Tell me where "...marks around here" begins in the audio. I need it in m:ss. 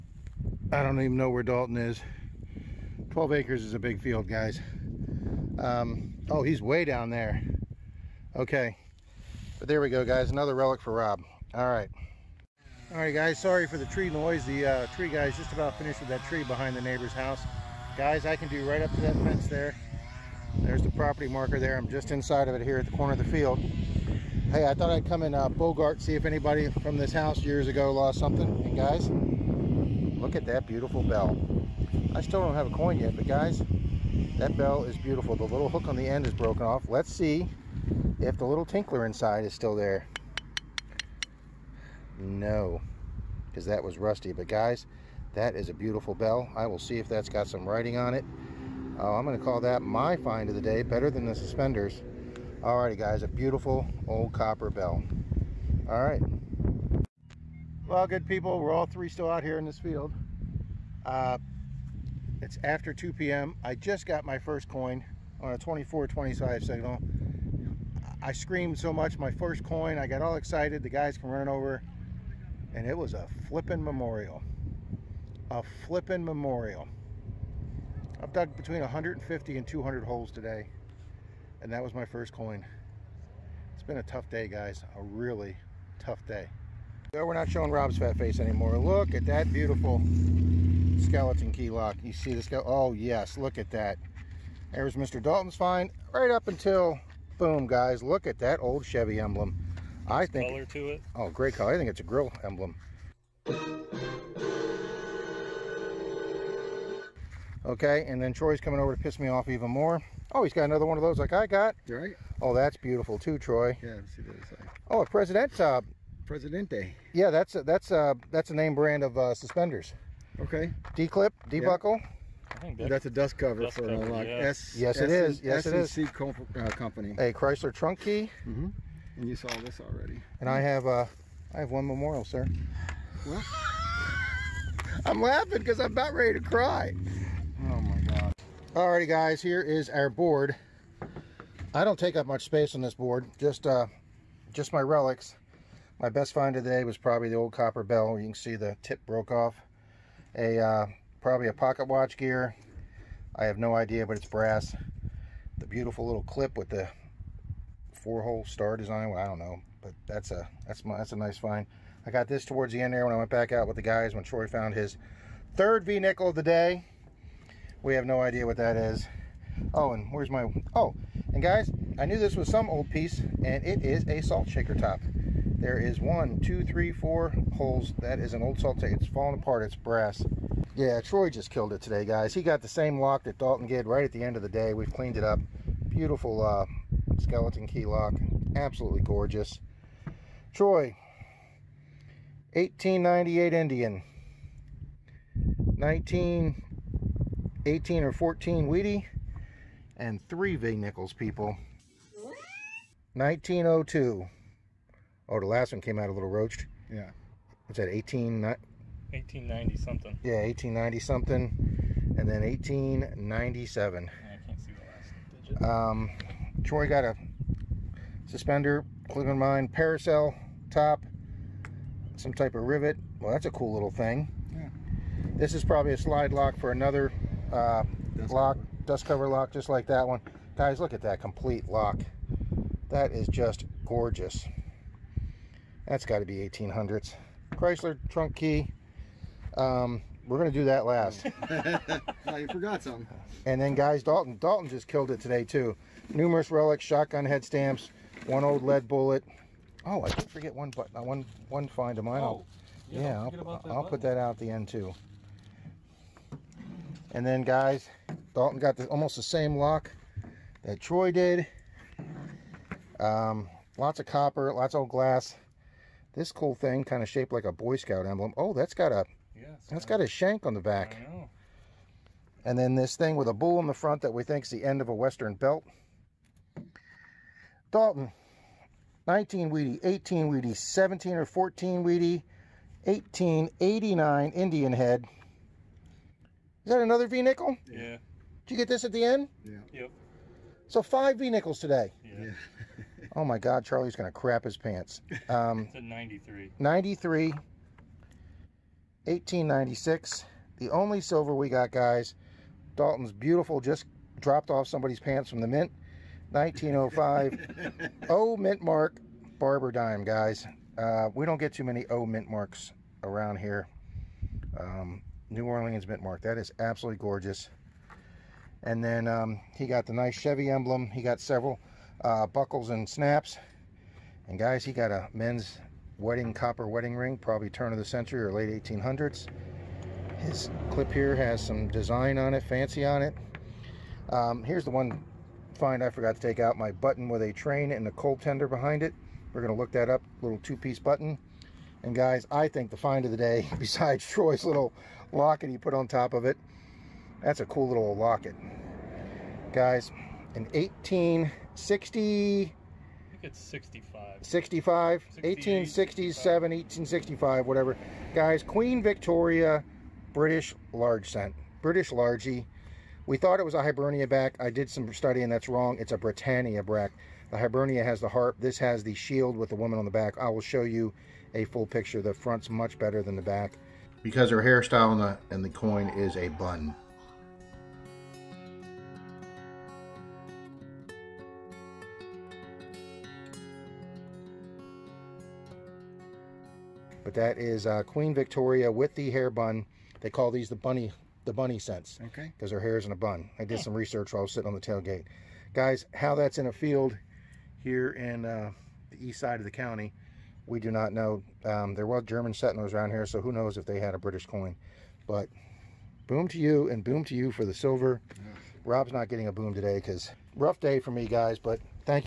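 5:12.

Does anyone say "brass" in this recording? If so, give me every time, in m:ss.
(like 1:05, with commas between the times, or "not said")
2:34, 2:59.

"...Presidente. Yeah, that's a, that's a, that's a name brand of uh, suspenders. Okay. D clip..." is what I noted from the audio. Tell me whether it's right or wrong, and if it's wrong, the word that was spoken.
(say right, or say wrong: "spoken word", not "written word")
right.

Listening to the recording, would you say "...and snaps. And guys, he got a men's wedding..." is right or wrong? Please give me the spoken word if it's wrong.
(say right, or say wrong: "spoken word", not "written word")
right.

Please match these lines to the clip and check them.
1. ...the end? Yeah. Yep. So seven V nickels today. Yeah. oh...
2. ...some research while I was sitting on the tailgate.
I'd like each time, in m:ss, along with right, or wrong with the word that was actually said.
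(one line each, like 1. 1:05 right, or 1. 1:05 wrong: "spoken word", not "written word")
1. 4:48 wrong: "five", not "seven"
2. 6:33 right.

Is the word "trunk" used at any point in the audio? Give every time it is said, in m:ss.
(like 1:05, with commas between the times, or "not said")
2:07, 3:58.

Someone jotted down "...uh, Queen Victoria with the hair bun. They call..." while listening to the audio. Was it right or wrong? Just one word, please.
right.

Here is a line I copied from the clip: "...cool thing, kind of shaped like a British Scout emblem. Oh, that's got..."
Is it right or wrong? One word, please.
wrong.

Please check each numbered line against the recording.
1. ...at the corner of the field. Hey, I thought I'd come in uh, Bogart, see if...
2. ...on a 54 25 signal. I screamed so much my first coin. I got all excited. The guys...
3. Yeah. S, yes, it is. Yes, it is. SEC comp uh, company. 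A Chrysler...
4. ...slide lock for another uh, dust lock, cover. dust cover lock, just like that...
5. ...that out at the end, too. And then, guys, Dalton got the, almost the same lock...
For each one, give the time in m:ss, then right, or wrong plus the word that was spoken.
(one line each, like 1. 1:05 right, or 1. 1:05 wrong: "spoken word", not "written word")
1. 0:22 right
2. 1:05 wrong: "24", not "54"
3. 2:04 right
4. 3:45 right
5. 4:14 right.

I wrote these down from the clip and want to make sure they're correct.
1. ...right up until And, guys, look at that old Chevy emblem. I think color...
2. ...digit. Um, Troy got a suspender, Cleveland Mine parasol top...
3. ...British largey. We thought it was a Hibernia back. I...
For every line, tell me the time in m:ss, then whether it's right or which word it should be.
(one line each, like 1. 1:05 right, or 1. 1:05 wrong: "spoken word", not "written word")
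1. 1:36 wrong: "Boom", not "And"
2. 3:35 right
3. 6:01 right.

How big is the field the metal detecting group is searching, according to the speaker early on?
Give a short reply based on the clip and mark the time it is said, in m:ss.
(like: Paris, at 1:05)
12 acres, at 0:03.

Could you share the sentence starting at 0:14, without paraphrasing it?
The uh, tree guy's just about finished with that tree behind the neighbor's house.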